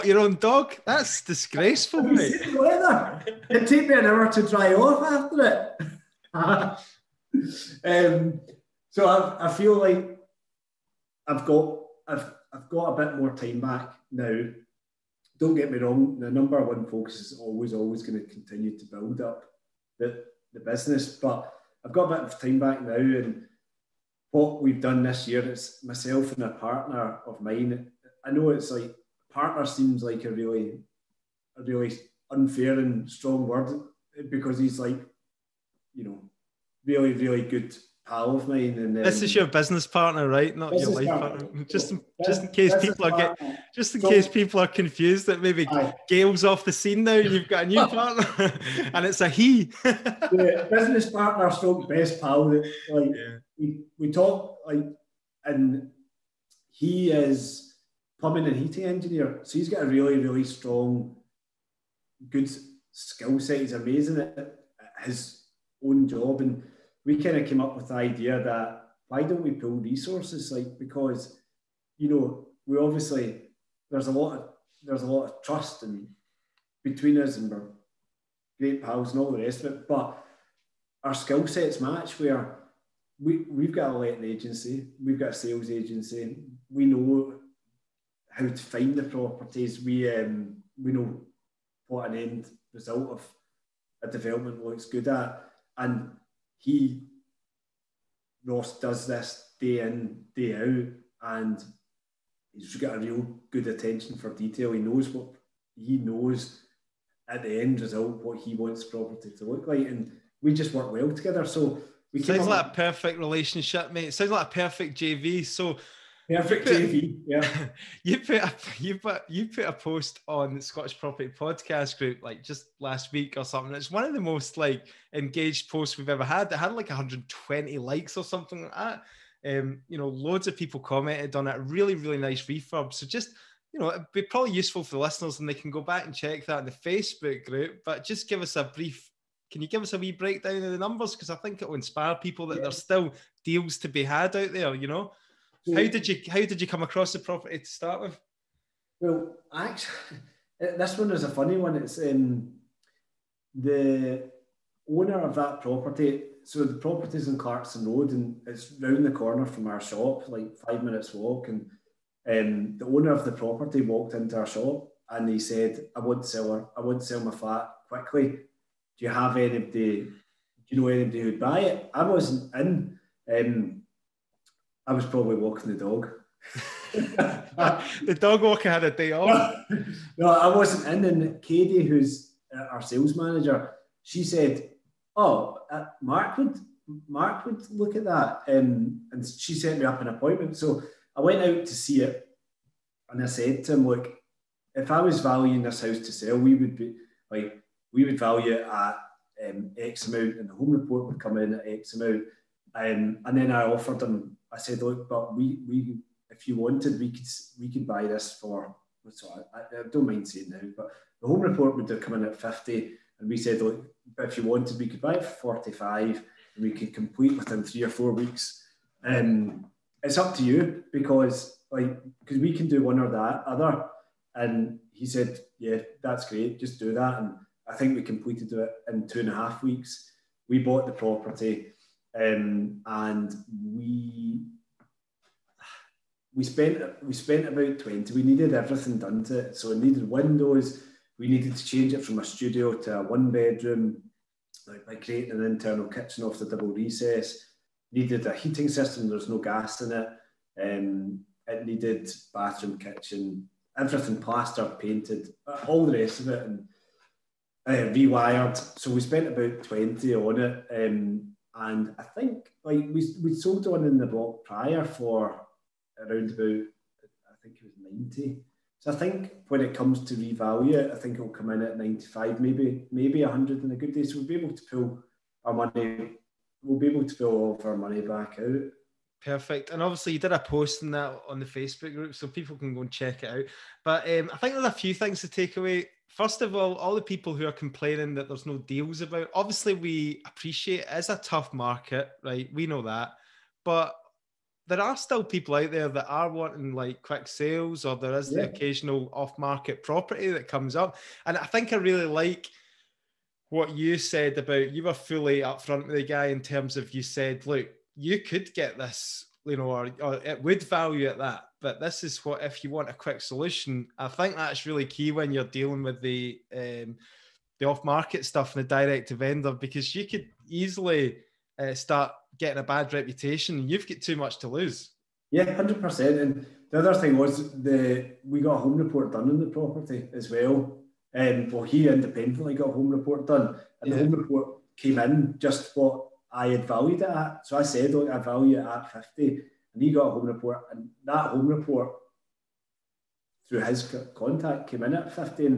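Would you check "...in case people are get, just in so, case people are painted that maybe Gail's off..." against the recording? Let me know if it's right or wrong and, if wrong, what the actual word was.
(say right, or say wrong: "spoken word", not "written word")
wrong: "confused", not "painted".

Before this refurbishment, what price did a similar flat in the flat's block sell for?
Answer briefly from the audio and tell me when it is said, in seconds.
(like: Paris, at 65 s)
90, at 268 s.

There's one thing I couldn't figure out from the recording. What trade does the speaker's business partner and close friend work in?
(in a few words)
Plumbing and heating engineer.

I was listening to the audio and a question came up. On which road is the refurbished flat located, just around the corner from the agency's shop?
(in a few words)
Clarkston Road.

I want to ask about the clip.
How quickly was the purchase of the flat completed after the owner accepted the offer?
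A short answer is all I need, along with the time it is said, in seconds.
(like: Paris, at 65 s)
2 and a half weeks, at 229 s.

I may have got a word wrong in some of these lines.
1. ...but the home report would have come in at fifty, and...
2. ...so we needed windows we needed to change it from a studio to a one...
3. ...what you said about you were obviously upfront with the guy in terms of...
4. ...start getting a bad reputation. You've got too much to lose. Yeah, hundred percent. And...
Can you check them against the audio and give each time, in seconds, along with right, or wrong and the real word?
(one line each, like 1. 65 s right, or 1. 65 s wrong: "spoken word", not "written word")
1. 210 s right
2. 239 s right
3. 303 s wrong: "fully", not "obviously"
4. 321 s right.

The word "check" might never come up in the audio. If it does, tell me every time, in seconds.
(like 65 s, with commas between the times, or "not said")
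136 s, 282 s.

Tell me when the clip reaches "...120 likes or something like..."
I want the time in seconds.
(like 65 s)
126 s.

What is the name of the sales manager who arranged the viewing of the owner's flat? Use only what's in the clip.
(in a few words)
Katie.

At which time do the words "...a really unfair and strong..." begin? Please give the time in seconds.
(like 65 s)
31 s.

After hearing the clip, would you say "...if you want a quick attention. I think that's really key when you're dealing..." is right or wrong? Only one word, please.
wrong.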